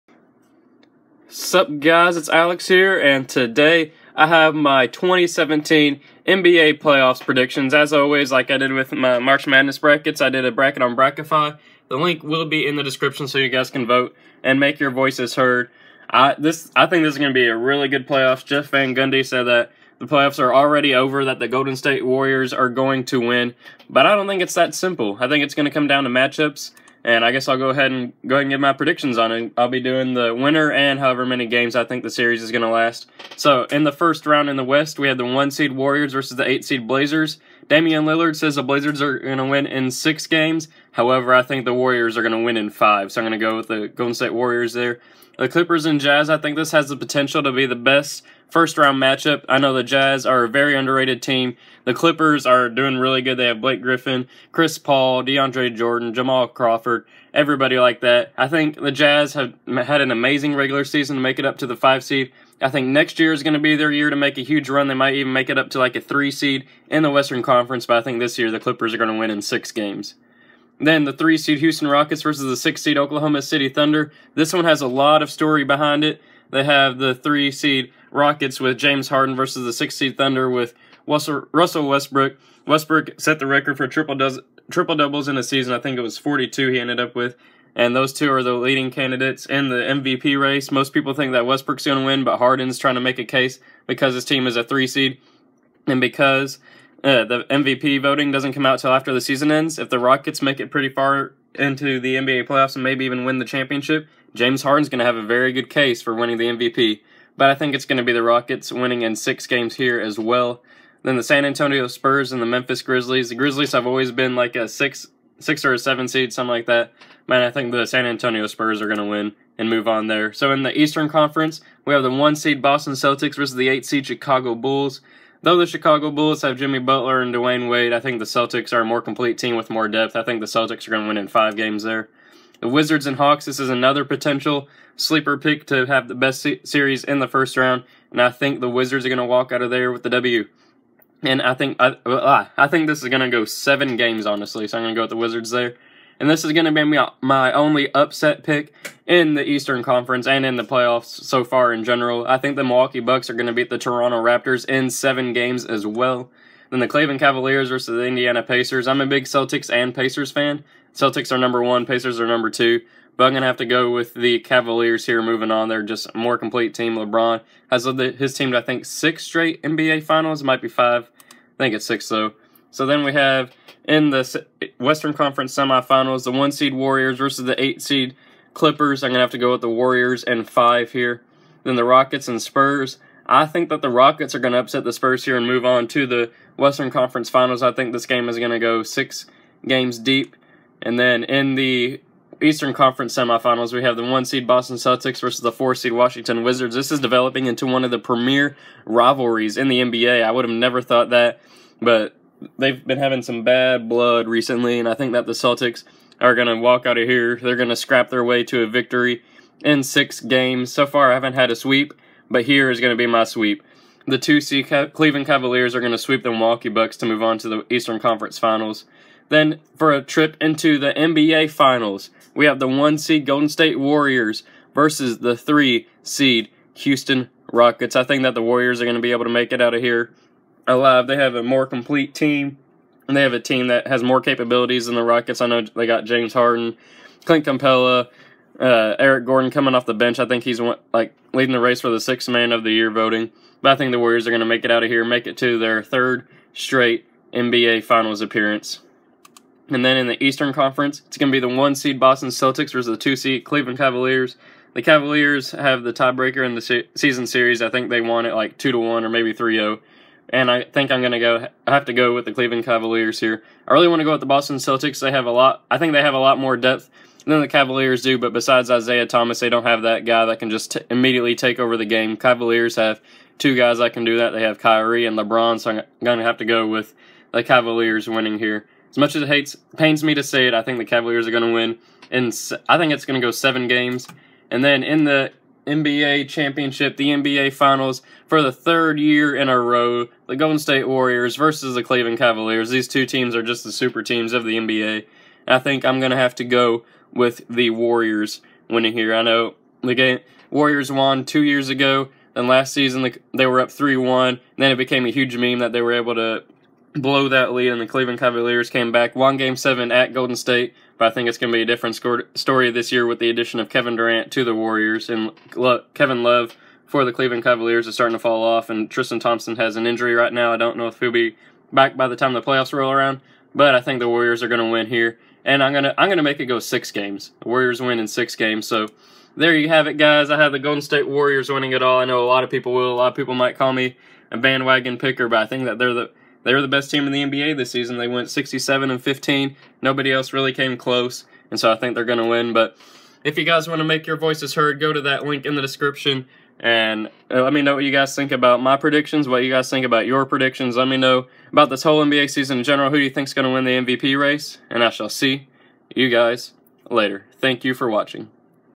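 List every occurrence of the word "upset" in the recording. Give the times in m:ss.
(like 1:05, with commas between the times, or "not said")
2:27, 3:04.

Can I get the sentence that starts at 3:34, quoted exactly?
The 2 seed Cleveland Cavaliers are going to sweep the Milwaukee Bucks to move on to the Eastern Conference Finals.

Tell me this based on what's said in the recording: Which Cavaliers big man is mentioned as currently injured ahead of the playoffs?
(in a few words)
Tristan Thompson.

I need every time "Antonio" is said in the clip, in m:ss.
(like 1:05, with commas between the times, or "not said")
1:51, 1:58.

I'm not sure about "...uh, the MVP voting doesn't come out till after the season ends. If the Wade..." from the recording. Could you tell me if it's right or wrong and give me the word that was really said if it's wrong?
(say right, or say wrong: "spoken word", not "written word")
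wrong: "Rockets", not "Wade".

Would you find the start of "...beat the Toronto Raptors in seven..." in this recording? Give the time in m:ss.
2:33.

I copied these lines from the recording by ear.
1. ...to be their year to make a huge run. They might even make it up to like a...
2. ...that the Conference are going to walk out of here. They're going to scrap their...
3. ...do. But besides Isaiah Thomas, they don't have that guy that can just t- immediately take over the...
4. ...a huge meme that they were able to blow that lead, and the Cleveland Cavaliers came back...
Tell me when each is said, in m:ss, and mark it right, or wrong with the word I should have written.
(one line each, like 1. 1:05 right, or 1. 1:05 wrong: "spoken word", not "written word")
1. 1:03 right
2. 3:25 wrong: "Celtics", not "Conference"
3. 4:28 right
4. 5:05 right.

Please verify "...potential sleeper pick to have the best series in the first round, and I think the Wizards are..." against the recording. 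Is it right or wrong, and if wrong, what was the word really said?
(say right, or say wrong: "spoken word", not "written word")
right.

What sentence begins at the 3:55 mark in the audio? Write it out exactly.
I know they got James Harden, Clint Capela, uh, Eric Gordon coming off the bench.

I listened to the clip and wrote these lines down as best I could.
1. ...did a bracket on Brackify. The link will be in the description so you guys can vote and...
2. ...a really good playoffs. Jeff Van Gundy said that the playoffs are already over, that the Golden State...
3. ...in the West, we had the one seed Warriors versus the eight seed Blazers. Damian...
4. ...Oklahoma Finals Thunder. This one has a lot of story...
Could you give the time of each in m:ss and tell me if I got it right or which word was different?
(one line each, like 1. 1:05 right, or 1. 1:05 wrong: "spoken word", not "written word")
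1. 0:10 right
2. 0:17 right
3. 0:34 right
4. 1:12 wrong: "City", not "Finals".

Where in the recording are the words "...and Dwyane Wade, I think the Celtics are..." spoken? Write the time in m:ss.
2:07.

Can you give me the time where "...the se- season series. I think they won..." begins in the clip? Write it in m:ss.
4:16.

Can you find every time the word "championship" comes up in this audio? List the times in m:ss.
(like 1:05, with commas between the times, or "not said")
1:43, 4:46.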